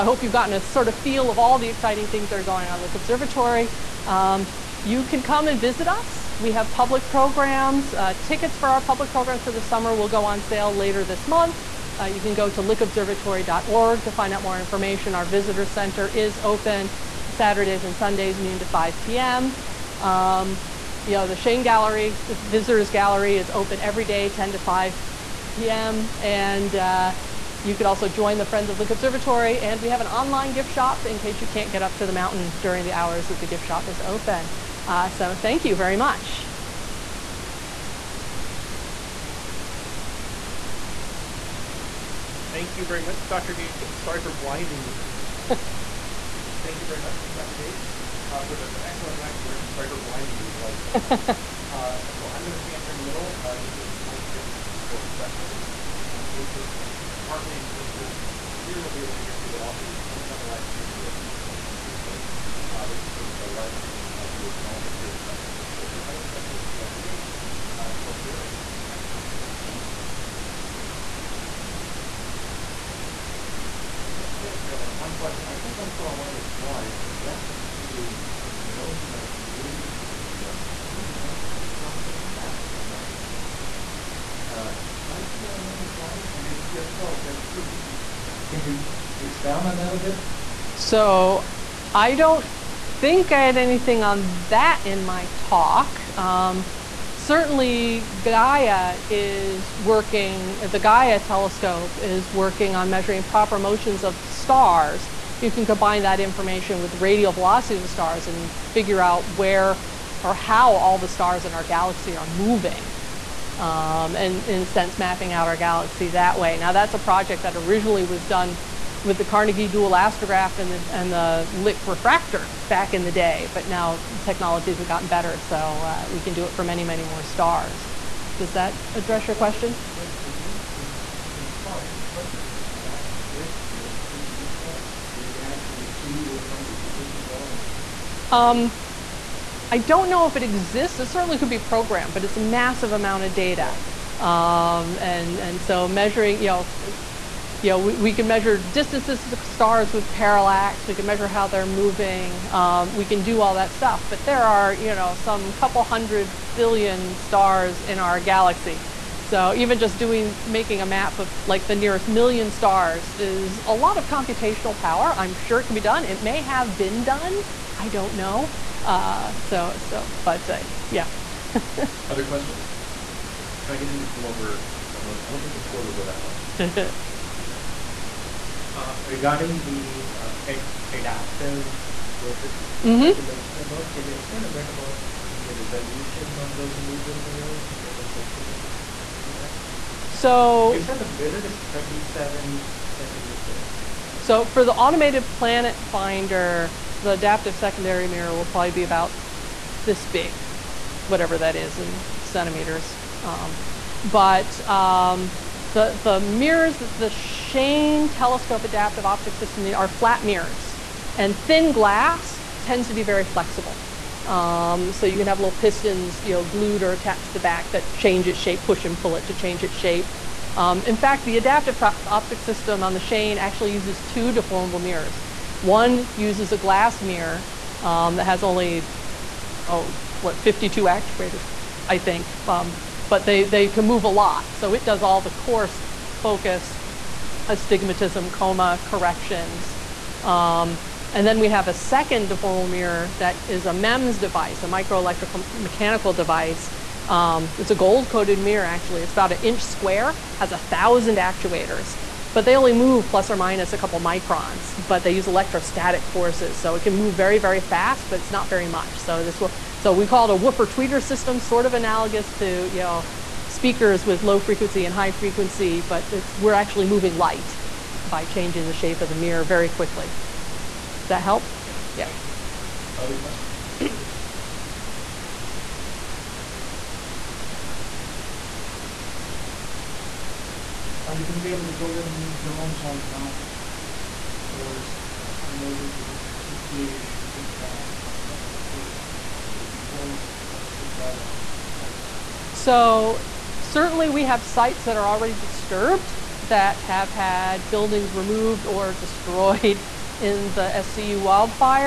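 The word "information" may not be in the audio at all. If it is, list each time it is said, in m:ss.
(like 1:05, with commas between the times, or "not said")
0:14, 1:46.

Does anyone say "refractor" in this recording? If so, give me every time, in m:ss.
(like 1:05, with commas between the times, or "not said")
2:01.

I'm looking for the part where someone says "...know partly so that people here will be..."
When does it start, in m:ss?
0:56.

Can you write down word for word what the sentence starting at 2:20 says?
It certainly could be programmed, but it's a massive amount of data.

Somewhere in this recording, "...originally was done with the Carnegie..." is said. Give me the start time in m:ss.
1:57.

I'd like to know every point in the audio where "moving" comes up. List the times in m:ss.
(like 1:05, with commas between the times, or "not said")
1:52, 2:31, 4:26.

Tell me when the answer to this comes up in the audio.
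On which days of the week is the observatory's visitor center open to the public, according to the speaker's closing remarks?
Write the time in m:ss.
0:17.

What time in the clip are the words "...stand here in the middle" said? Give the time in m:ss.
0:52.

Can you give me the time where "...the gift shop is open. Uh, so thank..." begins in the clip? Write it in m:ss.
0:33.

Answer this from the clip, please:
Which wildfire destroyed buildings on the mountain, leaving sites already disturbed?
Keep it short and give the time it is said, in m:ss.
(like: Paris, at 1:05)
SCU wildfire, at 5:00.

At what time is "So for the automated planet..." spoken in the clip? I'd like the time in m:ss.
3:14.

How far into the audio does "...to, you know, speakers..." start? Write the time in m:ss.
4:22.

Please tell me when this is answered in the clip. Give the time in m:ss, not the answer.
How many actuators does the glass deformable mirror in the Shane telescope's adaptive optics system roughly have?
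3:50.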